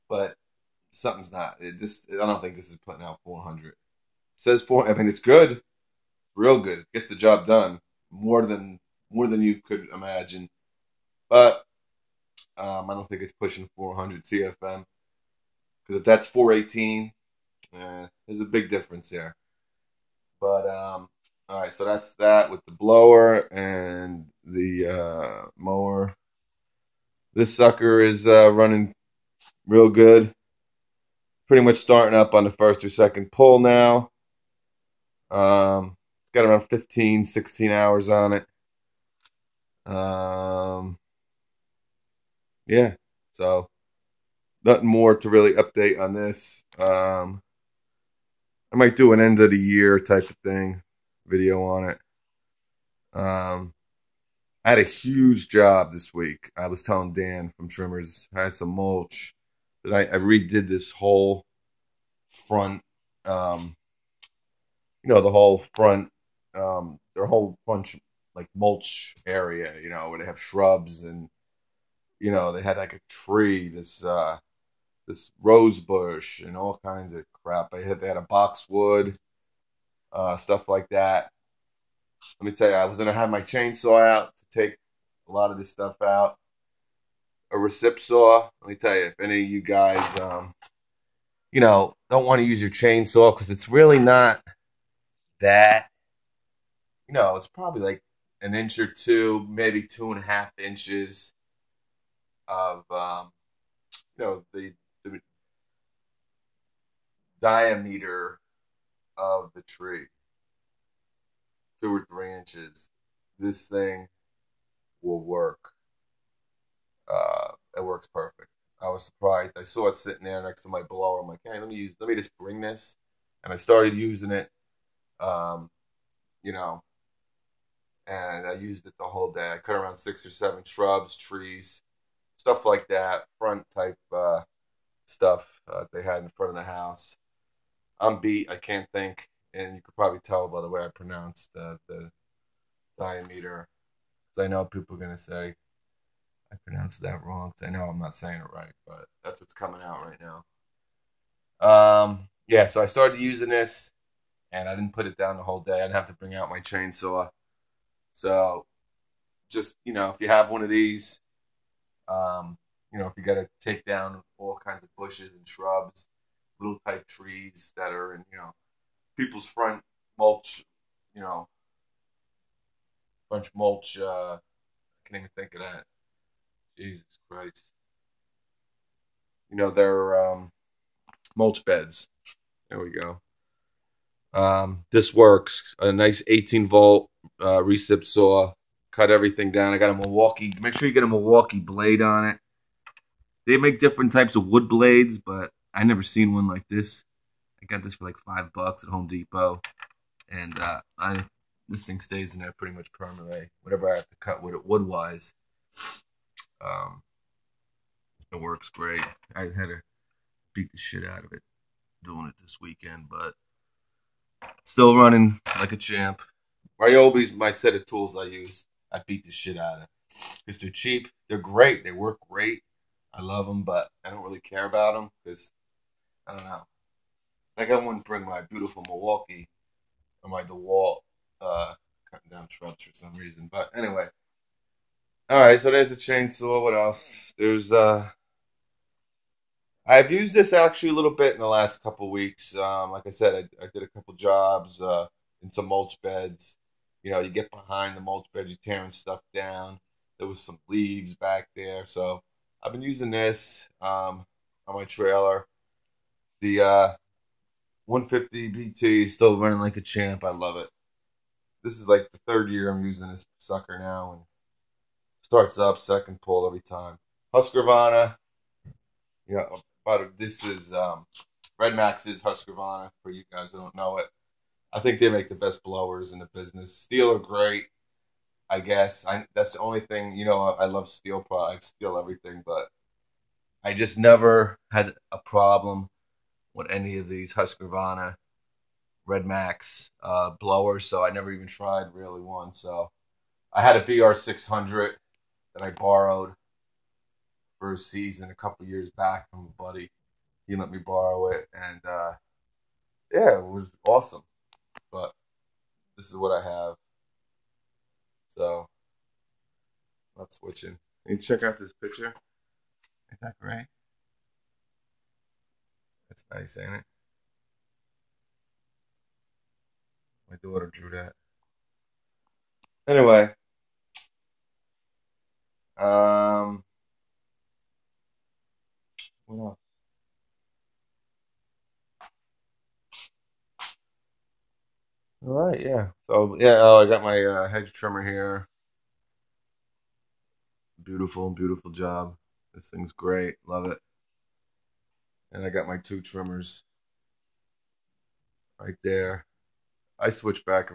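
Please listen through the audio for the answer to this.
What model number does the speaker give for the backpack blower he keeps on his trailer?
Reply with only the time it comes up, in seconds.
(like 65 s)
257 s.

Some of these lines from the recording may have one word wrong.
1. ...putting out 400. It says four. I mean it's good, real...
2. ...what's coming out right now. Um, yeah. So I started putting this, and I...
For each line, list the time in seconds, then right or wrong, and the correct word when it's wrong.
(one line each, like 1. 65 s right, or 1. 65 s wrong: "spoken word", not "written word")
1. 2 s right
2. 149 s wrong: "using", not "putting".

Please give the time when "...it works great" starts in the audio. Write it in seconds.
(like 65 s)
208 s.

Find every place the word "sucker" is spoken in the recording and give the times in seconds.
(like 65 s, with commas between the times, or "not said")
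27 s, 263 s.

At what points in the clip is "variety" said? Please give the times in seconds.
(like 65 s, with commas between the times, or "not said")
not said.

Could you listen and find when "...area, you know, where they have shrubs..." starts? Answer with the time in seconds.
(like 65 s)
69 s.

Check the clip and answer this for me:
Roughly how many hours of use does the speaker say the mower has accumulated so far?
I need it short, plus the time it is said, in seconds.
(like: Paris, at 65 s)
15, 16 hours, at 36 s.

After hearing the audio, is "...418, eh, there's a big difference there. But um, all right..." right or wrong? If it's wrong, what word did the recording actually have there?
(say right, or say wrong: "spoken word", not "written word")
right.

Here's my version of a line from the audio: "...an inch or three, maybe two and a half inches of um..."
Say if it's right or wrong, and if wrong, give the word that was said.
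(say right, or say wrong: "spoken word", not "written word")
wrong: "two", not "three".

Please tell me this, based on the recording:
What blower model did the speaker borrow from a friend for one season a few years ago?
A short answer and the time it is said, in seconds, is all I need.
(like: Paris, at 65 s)
BR 600, at 293 s.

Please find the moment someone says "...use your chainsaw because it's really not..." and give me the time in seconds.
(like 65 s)
92 s.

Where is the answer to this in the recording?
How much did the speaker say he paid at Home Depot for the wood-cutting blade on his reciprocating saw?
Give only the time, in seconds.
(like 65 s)
198 s.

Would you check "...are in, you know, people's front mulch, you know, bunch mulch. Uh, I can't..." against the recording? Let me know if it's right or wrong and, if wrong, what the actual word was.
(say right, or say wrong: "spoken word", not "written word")
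right.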